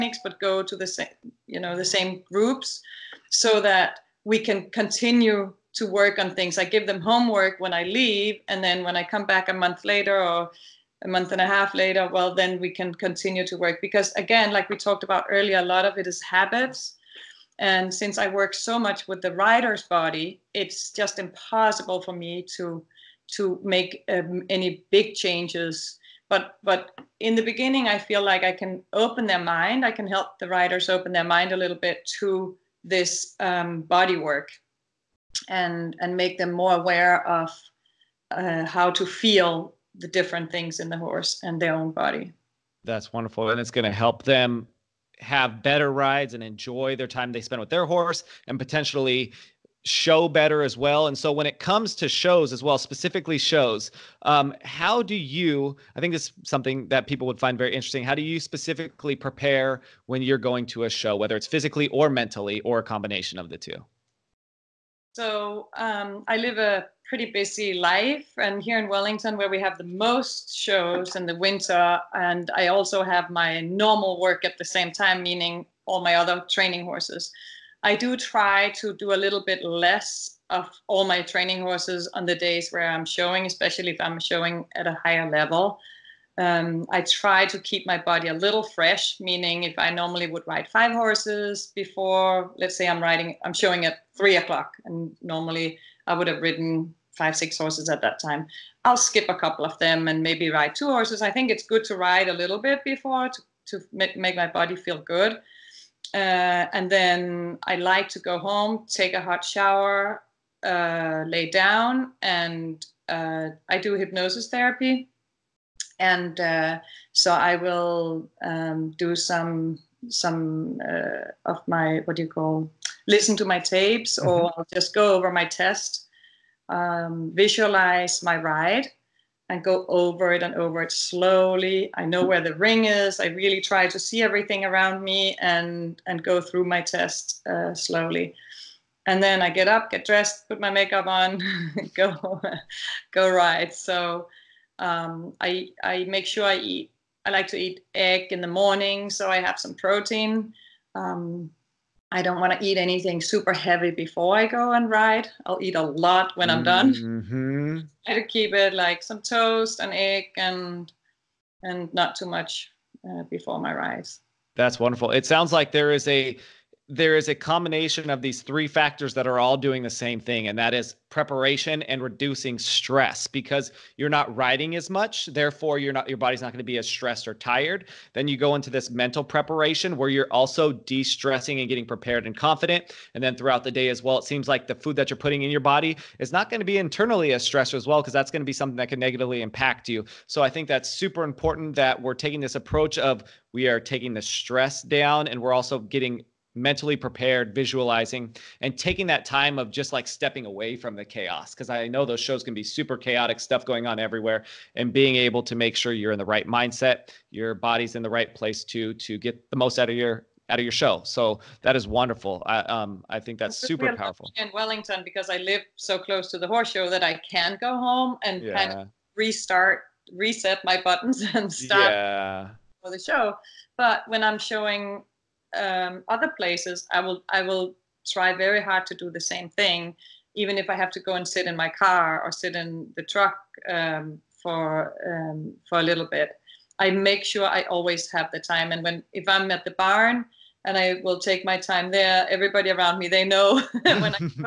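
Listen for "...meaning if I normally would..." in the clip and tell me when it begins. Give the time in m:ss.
1:29.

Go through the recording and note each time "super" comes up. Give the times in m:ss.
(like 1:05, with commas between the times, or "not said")
2:33, 3:10, 3:22, 3:33.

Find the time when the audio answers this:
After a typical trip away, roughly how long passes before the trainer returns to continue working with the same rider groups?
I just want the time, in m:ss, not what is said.
0:11.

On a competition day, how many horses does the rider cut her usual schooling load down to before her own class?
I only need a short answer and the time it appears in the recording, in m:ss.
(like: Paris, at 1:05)
2, at 1:40.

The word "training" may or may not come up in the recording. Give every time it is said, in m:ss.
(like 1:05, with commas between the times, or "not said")
1:16, 1:21.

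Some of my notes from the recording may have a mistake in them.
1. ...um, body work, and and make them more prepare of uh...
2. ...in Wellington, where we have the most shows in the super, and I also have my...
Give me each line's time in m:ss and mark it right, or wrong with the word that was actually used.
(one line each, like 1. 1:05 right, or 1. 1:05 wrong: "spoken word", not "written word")
1. 0:33 wrong: "aware", not "prepare"
2. 1:08 wrong: "winter", not "super".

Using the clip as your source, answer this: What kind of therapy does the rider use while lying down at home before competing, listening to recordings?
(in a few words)
hypnosis therapy.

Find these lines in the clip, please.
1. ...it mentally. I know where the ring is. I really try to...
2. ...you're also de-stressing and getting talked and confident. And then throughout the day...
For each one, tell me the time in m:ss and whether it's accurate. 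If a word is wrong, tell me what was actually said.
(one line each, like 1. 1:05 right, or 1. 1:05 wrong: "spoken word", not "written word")
1. 2:10 wrong: "slowly", not "mentally"
2. 3:00 wrong: "prepared", not "talked".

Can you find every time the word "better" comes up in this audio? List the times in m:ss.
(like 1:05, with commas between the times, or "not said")
0:45, 0:50.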